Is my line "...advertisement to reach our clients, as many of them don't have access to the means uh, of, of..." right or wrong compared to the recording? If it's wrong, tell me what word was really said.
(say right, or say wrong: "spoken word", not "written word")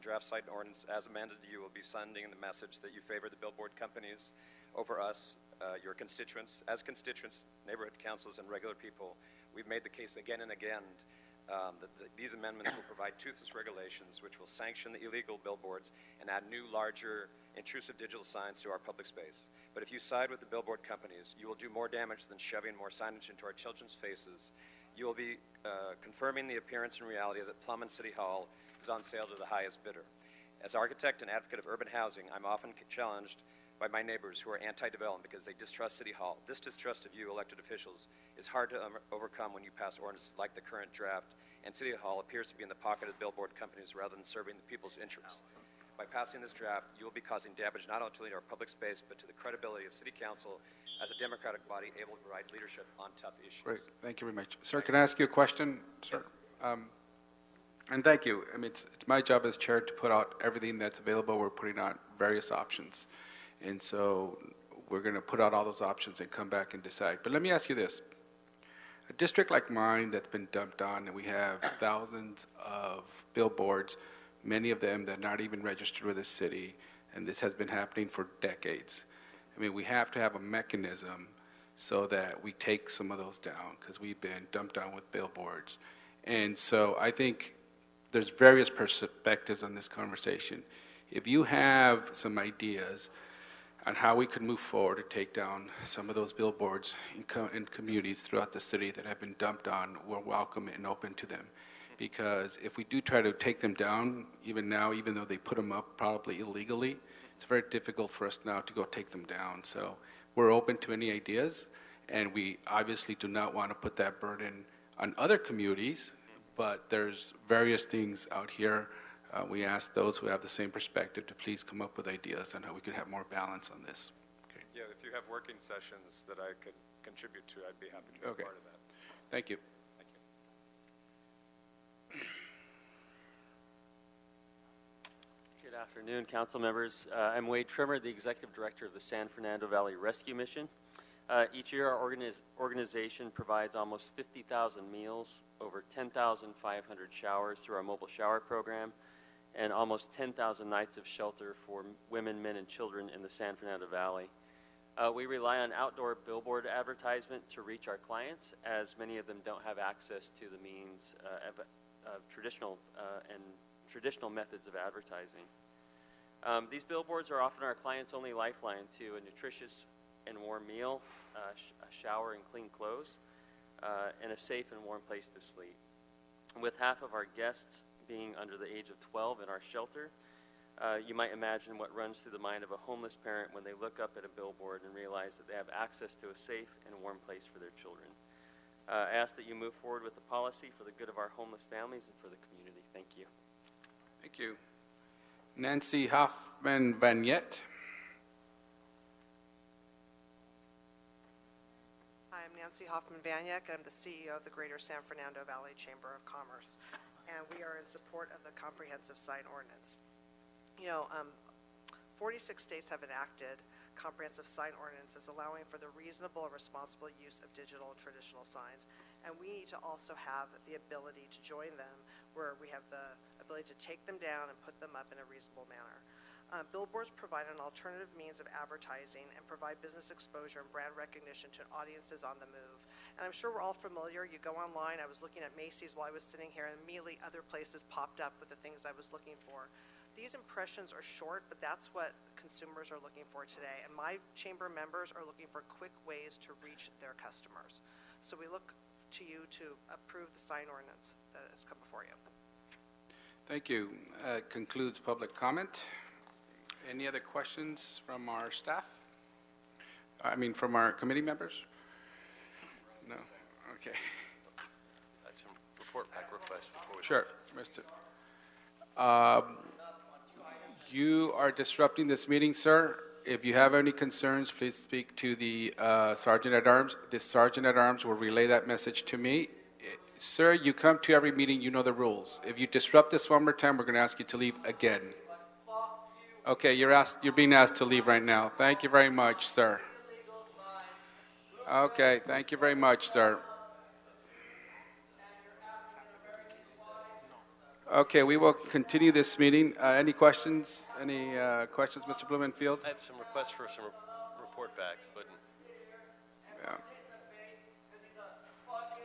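right.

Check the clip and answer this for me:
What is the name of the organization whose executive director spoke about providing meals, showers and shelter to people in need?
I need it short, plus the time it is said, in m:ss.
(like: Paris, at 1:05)
San Fernando Valley Rescue Mission, at 2:18.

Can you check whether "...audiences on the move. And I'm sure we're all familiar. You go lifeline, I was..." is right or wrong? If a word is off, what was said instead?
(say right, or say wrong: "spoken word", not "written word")
wrong: "online", not "lifeline".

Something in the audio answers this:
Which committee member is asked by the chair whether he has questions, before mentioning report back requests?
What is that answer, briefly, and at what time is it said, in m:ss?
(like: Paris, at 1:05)
Mr. Blumenfield, at 5:02.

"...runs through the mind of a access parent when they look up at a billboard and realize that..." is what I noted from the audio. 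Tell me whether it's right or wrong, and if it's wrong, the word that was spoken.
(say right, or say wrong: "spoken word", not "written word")
wrong: "homeless", not "access".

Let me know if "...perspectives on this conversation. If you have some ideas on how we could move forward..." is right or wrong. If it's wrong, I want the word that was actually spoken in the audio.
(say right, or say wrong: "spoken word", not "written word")
right.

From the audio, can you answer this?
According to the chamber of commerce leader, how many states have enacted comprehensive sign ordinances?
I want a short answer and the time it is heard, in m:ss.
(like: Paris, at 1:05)
46, at 3:32.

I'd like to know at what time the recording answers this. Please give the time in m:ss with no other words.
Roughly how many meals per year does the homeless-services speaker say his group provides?
2:24.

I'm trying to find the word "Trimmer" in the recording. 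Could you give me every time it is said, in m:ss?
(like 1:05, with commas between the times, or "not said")
2:17.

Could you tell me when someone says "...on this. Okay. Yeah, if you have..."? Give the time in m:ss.
2:03.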